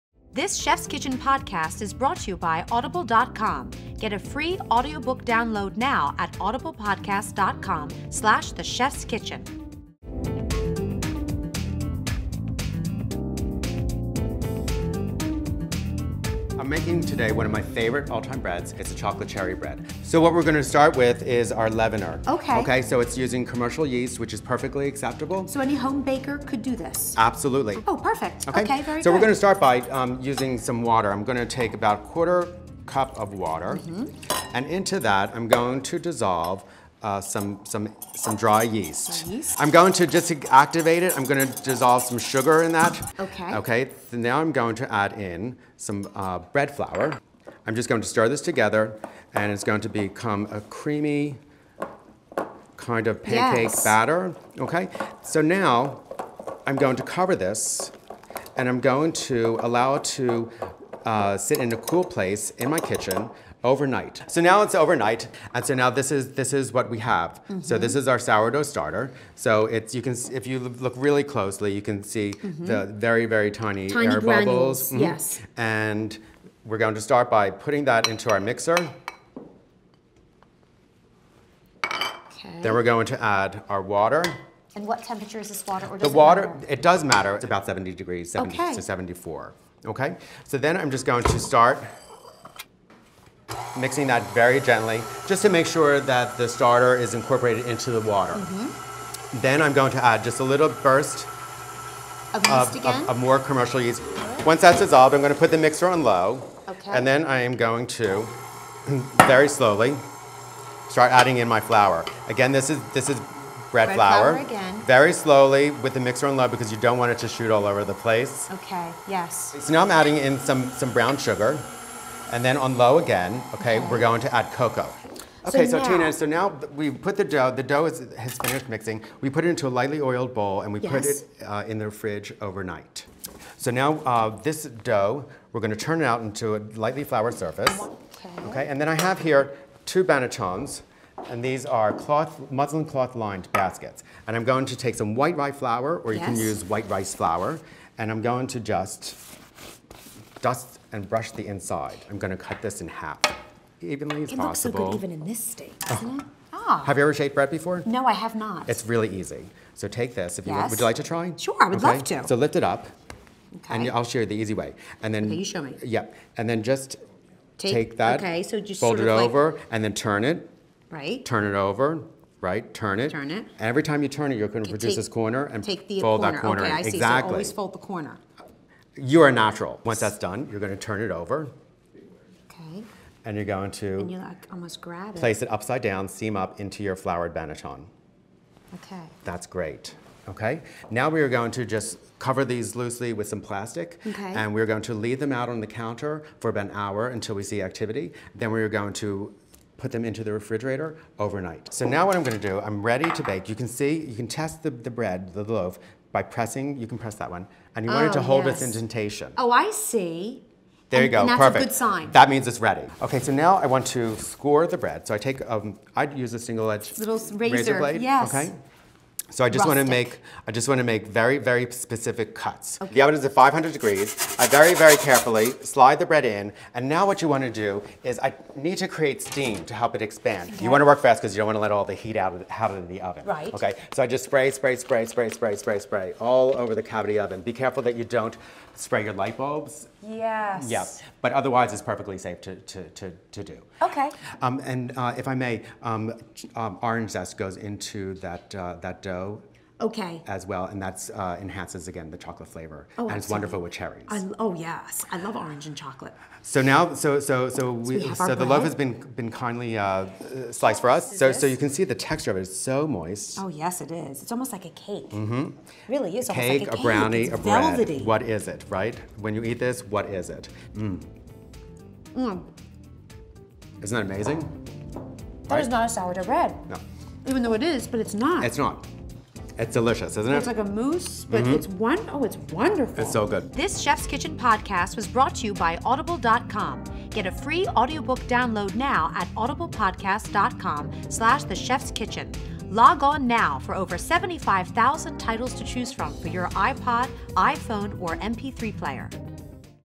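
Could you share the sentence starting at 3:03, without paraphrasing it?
And you're going to and you like almost grab it.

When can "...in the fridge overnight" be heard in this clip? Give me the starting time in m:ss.
2:11.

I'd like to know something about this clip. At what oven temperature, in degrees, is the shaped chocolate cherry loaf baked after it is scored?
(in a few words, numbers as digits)
500.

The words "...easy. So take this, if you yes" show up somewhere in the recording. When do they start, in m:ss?
2:39.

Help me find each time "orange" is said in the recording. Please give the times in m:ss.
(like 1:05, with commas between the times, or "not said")
4:06, 4:15.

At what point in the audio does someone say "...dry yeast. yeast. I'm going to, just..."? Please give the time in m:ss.
0:38.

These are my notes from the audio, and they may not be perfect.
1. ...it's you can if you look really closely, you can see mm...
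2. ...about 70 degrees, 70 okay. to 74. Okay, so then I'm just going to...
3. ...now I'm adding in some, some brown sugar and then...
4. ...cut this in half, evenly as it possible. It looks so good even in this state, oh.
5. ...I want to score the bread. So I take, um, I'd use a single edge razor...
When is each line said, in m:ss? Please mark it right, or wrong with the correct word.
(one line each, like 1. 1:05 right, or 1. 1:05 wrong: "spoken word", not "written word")
1. 1:09 right
2. 1:27 right
3. 1:59 right
4. 2:32 right
5. 3:33 right.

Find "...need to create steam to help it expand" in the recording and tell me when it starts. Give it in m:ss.
3:48.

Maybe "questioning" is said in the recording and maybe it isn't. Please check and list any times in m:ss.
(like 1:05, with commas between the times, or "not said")
not said.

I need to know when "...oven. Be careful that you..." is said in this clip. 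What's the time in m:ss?
3:57.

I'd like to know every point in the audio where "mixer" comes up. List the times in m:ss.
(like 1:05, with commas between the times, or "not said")
1:18, 1:45, 1:55.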